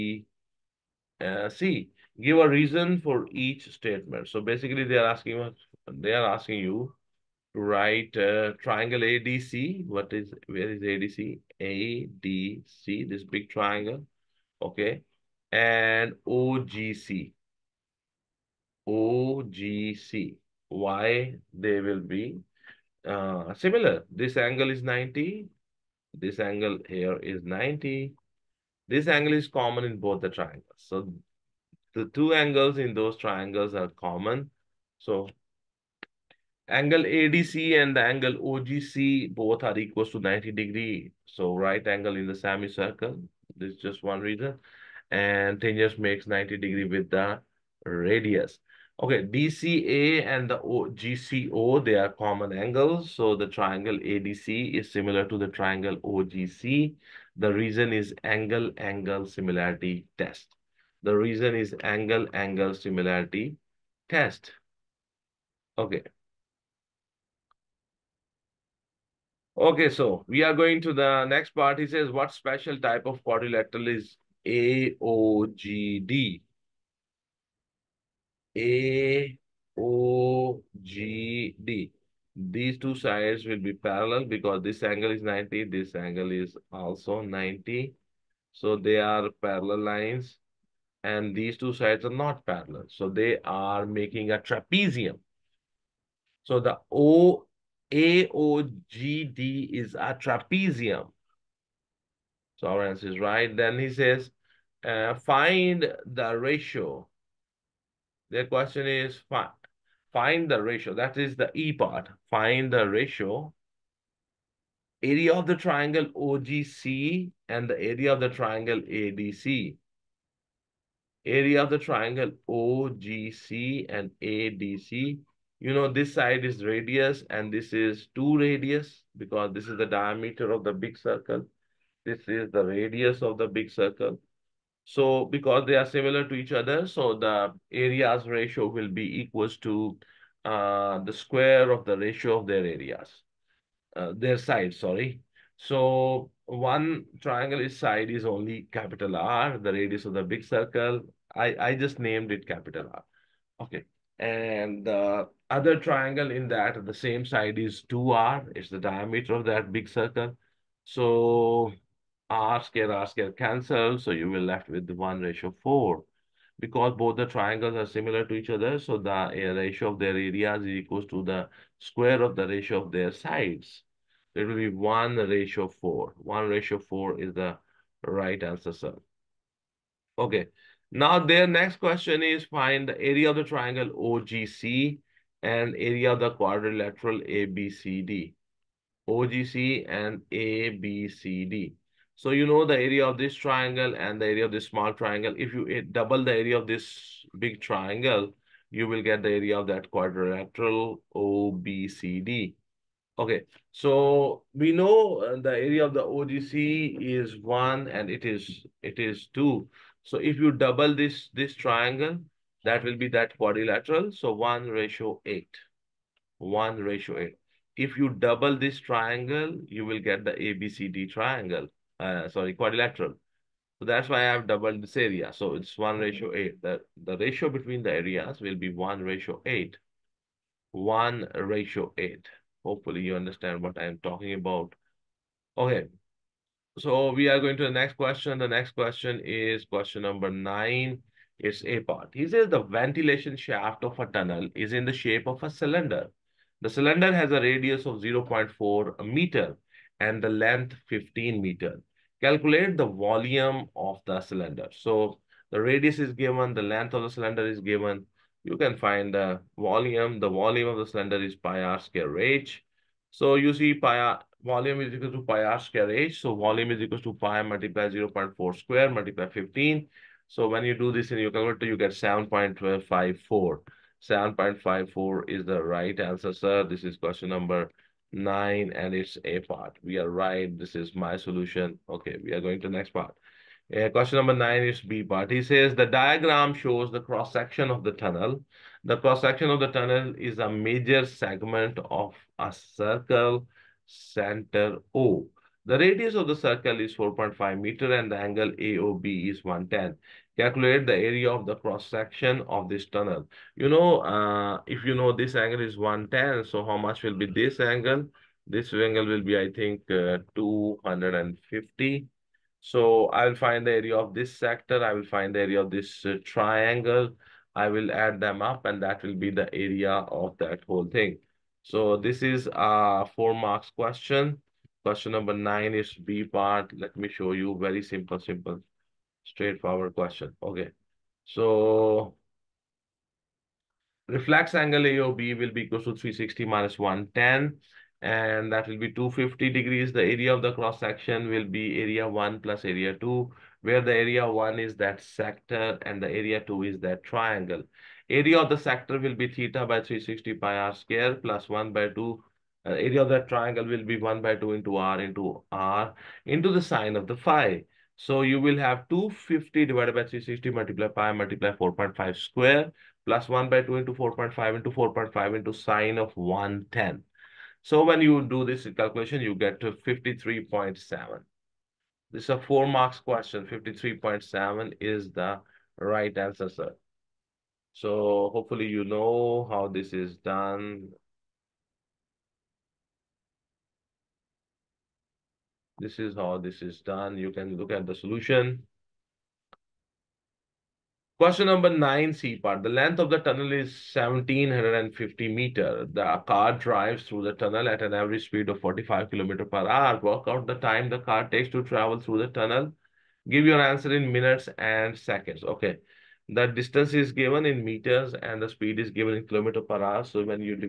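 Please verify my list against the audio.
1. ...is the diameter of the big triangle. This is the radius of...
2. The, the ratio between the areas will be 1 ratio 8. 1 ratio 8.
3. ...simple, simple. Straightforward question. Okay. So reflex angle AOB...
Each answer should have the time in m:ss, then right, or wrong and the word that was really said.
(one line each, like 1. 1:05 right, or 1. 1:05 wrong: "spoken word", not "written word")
1. 2:09 wrong: "circle", not "triangle"
2. 3:46 right
3. 5:27 right.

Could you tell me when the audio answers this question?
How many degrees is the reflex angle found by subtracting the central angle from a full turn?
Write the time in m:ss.
5:38.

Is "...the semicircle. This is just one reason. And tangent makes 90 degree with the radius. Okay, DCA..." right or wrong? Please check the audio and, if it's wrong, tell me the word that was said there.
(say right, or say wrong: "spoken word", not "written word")
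right.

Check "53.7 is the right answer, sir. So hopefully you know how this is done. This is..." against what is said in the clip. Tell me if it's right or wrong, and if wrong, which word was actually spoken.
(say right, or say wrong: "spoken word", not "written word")
right.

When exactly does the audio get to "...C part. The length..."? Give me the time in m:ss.
6:32.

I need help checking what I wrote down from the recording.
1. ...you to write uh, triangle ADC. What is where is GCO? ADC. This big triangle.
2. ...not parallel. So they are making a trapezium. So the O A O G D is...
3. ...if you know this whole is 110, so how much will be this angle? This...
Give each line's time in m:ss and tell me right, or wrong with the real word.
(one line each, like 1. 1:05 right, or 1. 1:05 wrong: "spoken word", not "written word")
1. 0:06 wrong: "ADC", not "GCO"
2. 1:32 right
3. 5:04 wrong: "angle", not "whole".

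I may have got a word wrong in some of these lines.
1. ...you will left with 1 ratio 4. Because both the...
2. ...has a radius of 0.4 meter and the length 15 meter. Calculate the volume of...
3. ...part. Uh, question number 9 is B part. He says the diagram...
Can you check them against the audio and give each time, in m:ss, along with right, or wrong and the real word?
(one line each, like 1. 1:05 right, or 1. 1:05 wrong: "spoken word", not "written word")
1. 2:44 right
2. 4:07 right
3. 4:42 right.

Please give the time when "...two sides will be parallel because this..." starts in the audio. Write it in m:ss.
1:22.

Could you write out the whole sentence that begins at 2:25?
So one triangle side is only capital R, the radius of the big circle.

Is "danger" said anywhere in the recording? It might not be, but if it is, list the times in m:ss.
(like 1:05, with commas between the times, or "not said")
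not said.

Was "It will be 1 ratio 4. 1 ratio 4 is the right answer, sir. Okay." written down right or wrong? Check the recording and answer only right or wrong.
right.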